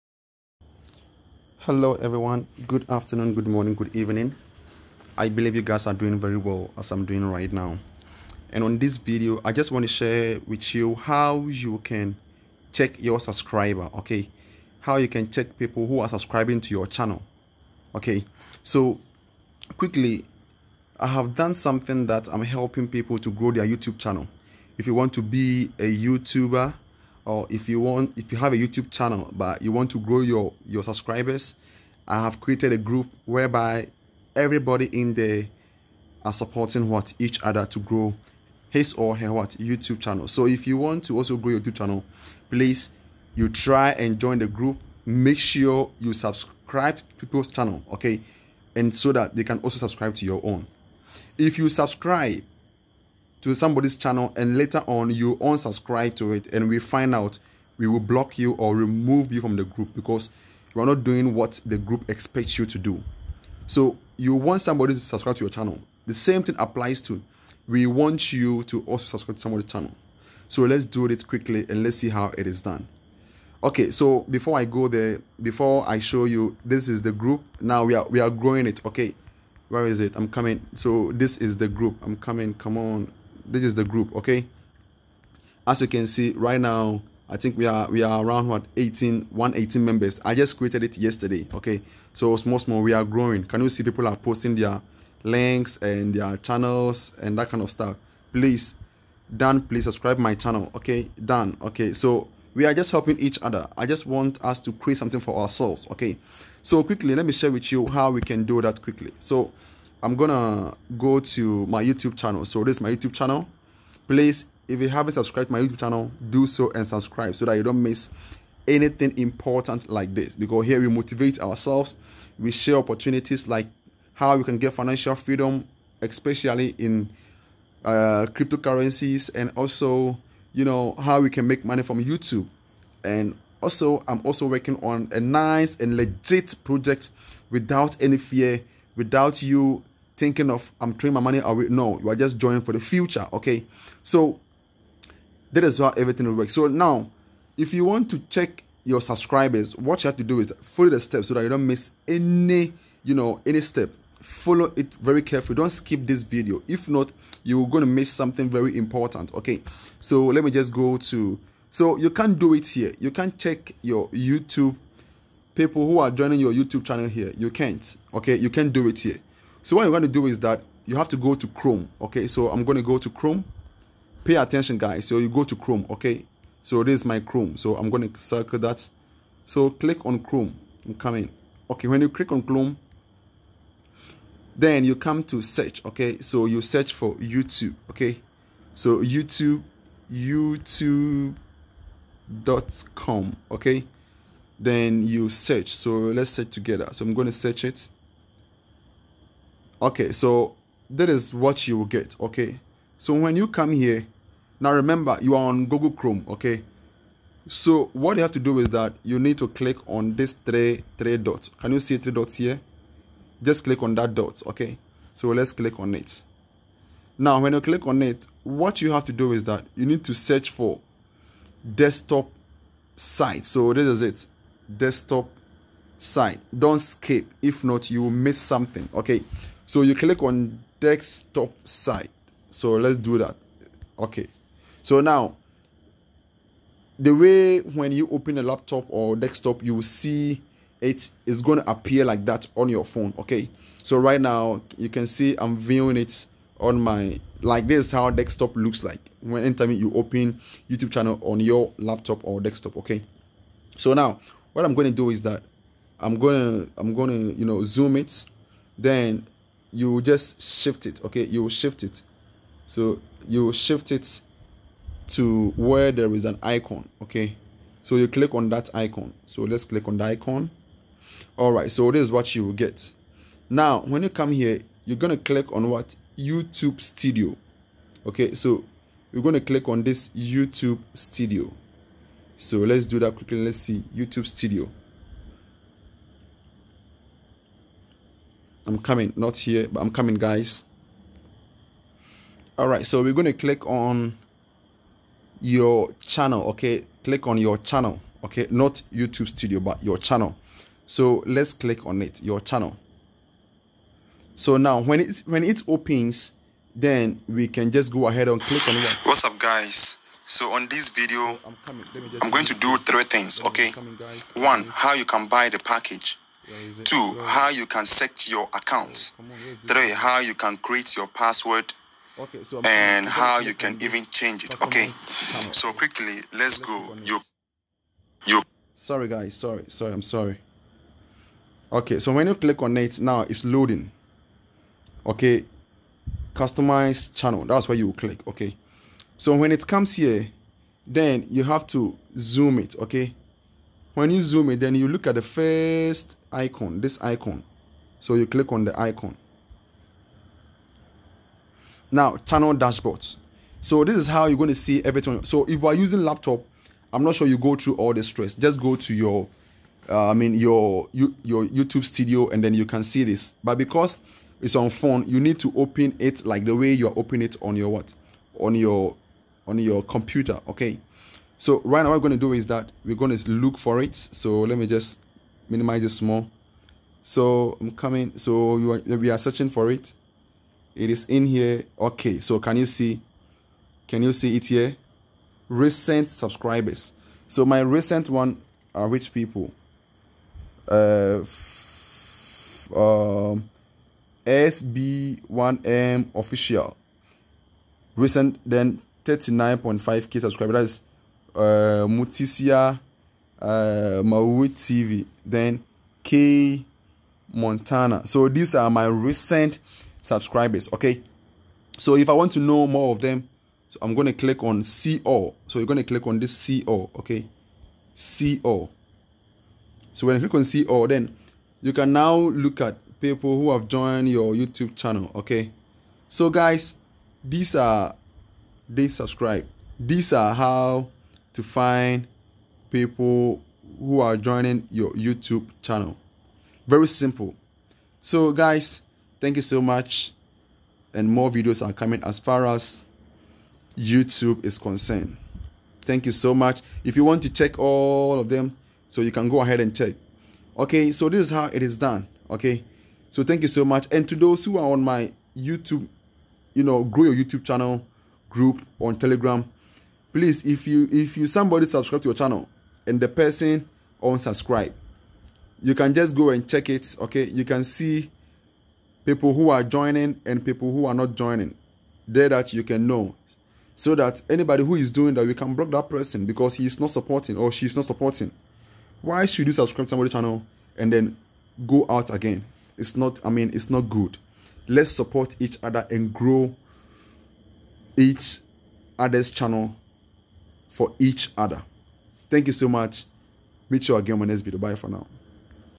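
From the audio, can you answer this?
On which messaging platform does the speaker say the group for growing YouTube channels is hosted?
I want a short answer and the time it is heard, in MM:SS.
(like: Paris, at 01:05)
Telegram, at 07:38.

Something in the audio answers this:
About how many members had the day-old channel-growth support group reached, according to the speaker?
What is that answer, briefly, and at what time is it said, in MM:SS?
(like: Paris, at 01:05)
118, at 01:29.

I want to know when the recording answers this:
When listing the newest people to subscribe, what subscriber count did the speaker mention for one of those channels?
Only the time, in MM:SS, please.
06:39.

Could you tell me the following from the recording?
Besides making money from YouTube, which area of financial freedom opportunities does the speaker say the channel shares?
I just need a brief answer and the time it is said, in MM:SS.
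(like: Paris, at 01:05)
Cryptocurrencies, at 02:08.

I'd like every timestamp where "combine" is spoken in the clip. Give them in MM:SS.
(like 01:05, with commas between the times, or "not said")
not said.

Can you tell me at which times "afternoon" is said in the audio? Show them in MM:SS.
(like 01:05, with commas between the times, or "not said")
00:02.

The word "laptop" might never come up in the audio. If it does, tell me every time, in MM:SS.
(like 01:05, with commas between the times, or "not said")
03:58, 04:11, 05:56.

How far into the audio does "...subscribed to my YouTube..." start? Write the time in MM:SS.
01:55.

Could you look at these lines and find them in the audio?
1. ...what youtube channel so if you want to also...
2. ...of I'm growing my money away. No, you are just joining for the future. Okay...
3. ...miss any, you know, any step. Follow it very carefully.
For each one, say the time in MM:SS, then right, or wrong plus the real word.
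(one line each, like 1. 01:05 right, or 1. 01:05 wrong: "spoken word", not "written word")
1. 00:39 right
2. 02:20 wrong: "throwing", not "growing"
3. 02:31 right.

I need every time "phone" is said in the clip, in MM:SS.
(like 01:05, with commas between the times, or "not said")
04:02, 06:04.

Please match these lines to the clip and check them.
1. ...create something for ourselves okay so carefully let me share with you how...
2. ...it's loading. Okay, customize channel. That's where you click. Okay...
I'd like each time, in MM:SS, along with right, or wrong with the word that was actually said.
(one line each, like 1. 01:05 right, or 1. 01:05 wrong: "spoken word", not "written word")
1. 01:44 wrong: "quickly", not "carefully"
2. 05:33 right.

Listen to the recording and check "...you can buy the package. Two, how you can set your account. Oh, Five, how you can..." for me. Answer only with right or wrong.
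wrong.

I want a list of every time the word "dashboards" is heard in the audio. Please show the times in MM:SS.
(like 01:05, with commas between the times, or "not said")
05:52.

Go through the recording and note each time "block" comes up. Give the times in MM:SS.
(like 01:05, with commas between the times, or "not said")
00:57, 07:55.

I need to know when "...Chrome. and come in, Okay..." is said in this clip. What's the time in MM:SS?
03:00.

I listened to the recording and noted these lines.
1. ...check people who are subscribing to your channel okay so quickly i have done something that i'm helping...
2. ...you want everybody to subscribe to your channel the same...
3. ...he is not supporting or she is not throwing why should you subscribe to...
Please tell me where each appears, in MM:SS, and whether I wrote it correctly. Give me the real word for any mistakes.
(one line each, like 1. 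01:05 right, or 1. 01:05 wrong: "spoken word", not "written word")
1. 00:15 right
2. 01:04 wrong: "somebody", not "everybody"
3. 07:56 wrong: "supporting", not "throwing".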